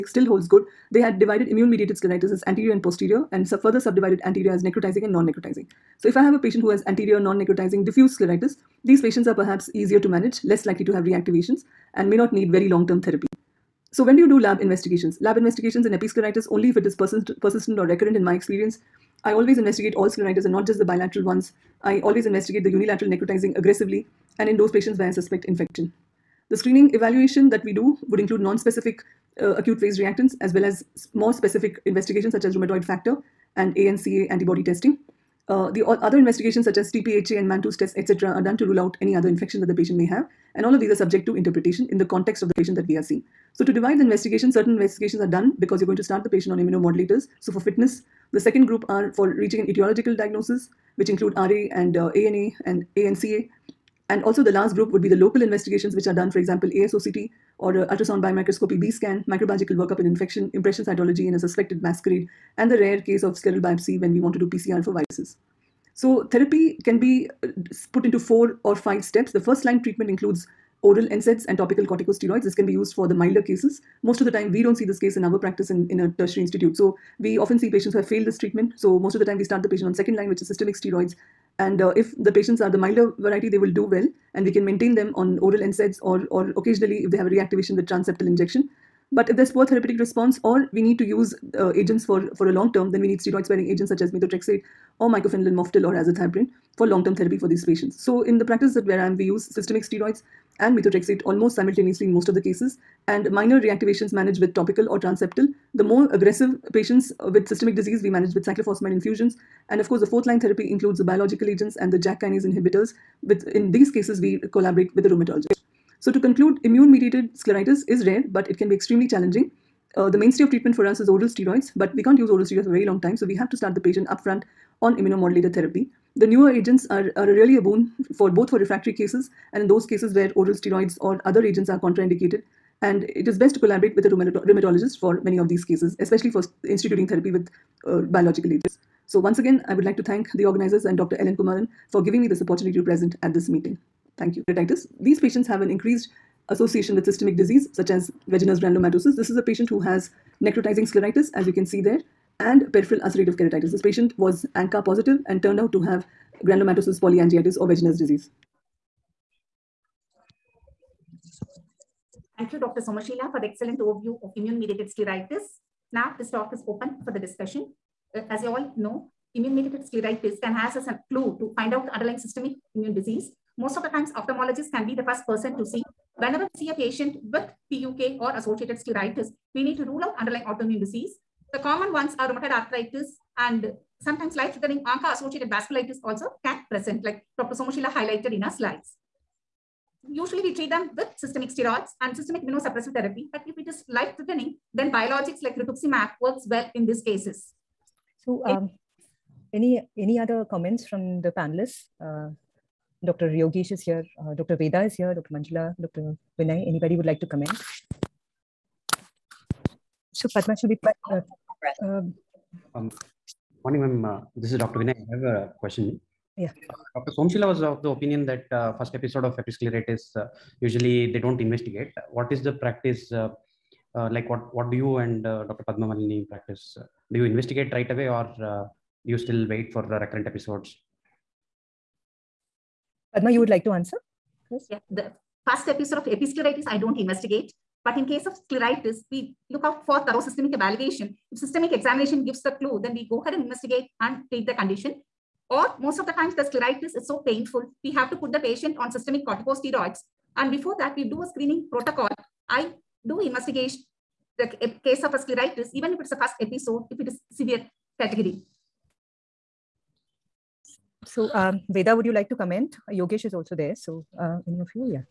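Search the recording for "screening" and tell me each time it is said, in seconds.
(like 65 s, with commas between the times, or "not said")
26 s, 251 s.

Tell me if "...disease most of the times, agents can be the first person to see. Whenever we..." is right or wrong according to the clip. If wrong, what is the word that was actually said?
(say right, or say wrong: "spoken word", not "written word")
wrong: "ophthalmologists", not "agents".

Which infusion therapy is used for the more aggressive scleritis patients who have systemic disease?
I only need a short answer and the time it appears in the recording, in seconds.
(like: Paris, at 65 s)
Cyclophosphamide, at 108 s.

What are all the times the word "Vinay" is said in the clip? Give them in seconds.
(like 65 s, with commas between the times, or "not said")
206 s, 214 s.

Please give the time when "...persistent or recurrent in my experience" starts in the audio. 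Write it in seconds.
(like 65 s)
17 s.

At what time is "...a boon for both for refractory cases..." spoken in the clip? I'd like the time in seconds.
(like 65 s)
127 s.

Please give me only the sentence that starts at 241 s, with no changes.
If systemic examination gives the clue, then we go ahead and investigate and treat the condition.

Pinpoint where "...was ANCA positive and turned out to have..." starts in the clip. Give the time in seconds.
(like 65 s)
154 s.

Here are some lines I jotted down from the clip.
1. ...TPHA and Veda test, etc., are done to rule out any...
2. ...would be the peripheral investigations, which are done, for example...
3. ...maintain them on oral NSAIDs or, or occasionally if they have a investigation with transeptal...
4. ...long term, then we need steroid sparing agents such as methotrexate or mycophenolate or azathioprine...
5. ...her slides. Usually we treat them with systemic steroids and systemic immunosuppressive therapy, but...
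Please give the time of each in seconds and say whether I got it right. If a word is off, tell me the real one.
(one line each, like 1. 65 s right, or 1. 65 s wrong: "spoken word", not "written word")
1. 36 s wrong: "Mantoux", not "Veda"
2. 54 s wrong: "local", not "peripheral"
3. 84 s wrong: "reactivation", not "investigation"
4. 92 s right
5. 188 s right.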